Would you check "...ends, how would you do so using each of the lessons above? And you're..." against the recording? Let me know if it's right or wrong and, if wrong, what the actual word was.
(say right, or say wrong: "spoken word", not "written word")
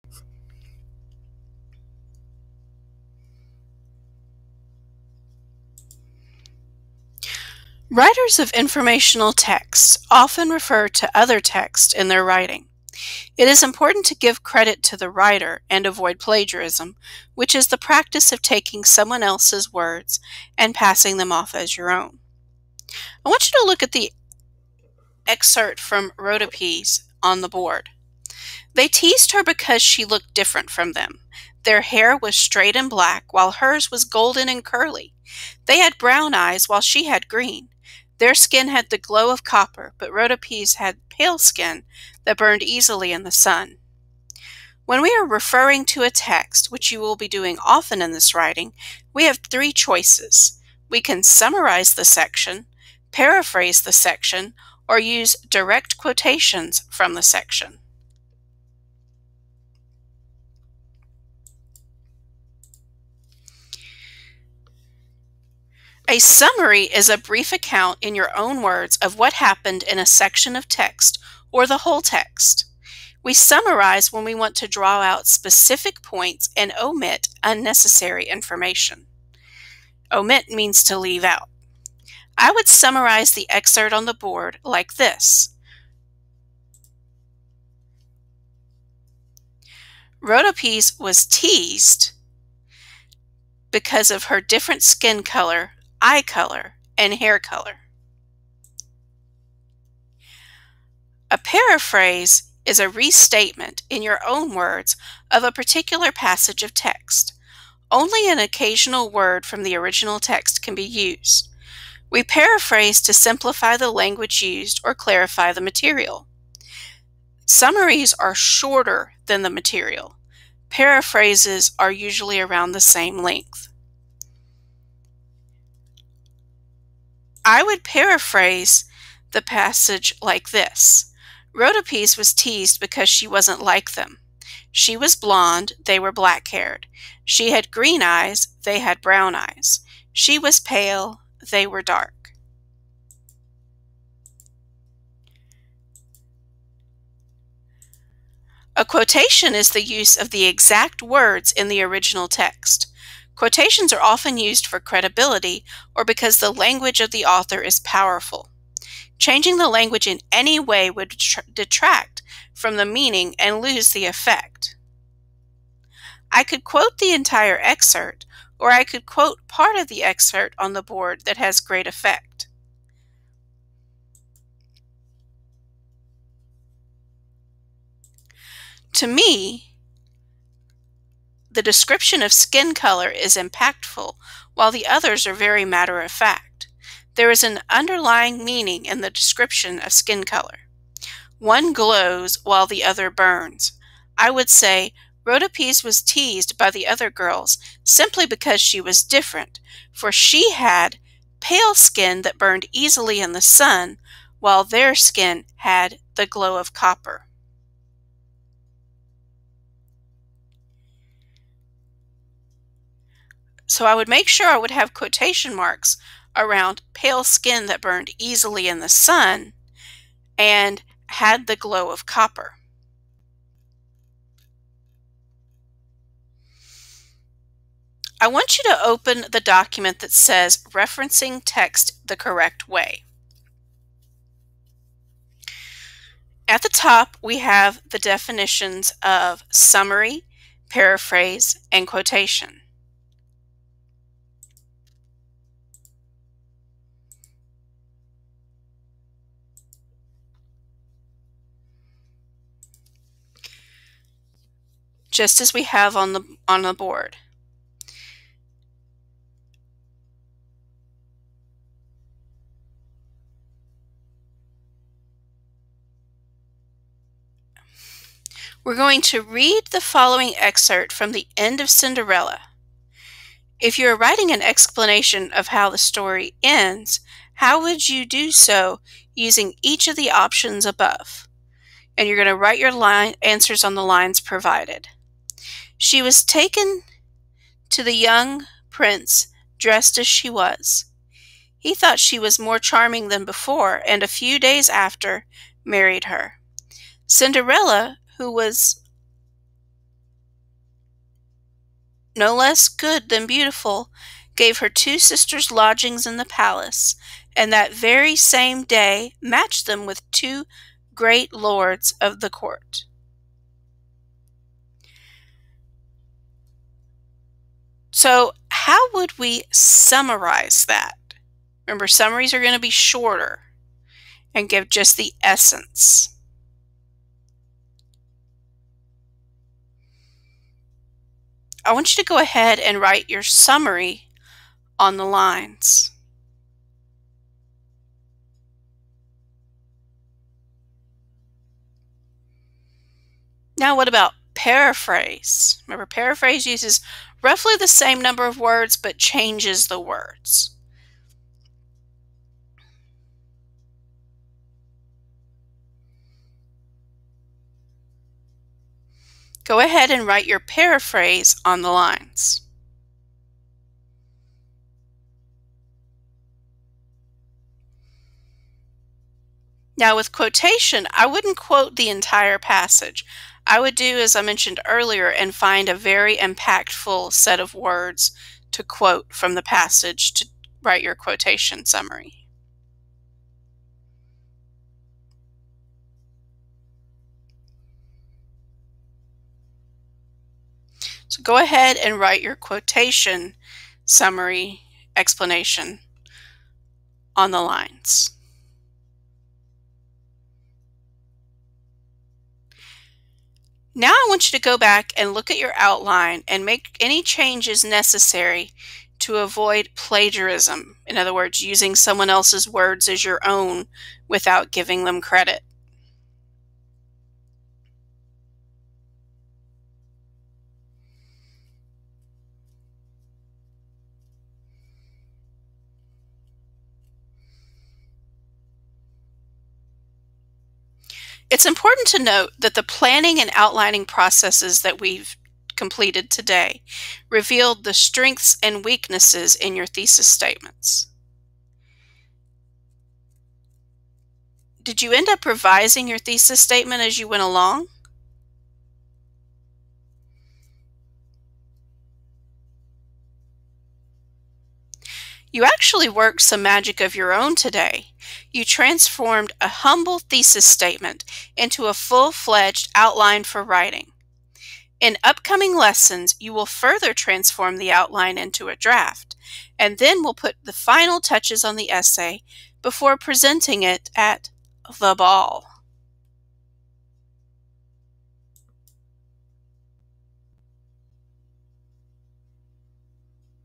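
wrong: "options", not "lessons".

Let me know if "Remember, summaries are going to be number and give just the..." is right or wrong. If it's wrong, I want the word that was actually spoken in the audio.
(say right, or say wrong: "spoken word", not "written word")
wrong: "shorter", not "number".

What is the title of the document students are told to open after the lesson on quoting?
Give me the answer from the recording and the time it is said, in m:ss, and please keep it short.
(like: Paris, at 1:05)
Referencing text the correct way, at 3:50.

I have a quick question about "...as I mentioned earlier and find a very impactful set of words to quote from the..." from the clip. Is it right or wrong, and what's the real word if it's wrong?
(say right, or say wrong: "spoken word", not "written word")
right.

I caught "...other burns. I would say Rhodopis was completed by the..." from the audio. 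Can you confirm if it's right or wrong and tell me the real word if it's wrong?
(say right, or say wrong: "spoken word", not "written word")
wrong: "teased", not "completed".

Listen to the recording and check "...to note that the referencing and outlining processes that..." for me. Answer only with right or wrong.
wrong.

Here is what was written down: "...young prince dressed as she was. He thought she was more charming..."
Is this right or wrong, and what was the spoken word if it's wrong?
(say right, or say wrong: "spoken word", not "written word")
right.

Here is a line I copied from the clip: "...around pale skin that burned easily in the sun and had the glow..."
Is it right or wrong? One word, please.
right.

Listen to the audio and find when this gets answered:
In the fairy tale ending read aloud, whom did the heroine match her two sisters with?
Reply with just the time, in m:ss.
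5:10.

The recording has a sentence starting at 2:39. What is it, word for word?
Changing the language in any way would detract from the meaning and lose the effect.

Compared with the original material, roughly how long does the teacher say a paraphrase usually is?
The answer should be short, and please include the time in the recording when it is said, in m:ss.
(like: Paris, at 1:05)
around the same length, at 2:02.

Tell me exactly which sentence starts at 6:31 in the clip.
So go ahead and write your quotation summary explanation on the lines.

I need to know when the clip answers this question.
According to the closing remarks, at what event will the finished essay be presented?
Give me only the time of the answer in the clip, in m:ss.
7:54.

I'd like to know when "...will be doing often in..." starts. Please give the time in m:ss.
0:46.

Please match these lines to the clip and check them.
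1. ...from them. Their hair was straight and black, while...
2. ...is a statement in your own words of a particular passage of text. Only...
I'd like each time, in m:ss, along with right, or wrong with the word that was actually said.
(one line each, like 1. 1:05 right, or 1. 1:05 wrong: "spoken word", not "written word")
1. 0:30 right
2. 1:42 wrong: "restatement", not "statement".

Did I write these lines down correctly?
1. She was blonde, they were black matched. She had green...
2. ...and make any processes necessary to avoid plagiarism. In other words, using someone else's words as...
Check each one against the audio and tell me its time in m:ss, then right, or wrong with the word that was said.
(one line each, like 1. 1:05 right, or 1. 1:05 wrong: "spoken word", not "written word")
1. 2:14 wrong: "haired", not "matched"
2. 6:46 wrong: "changes", not "processes".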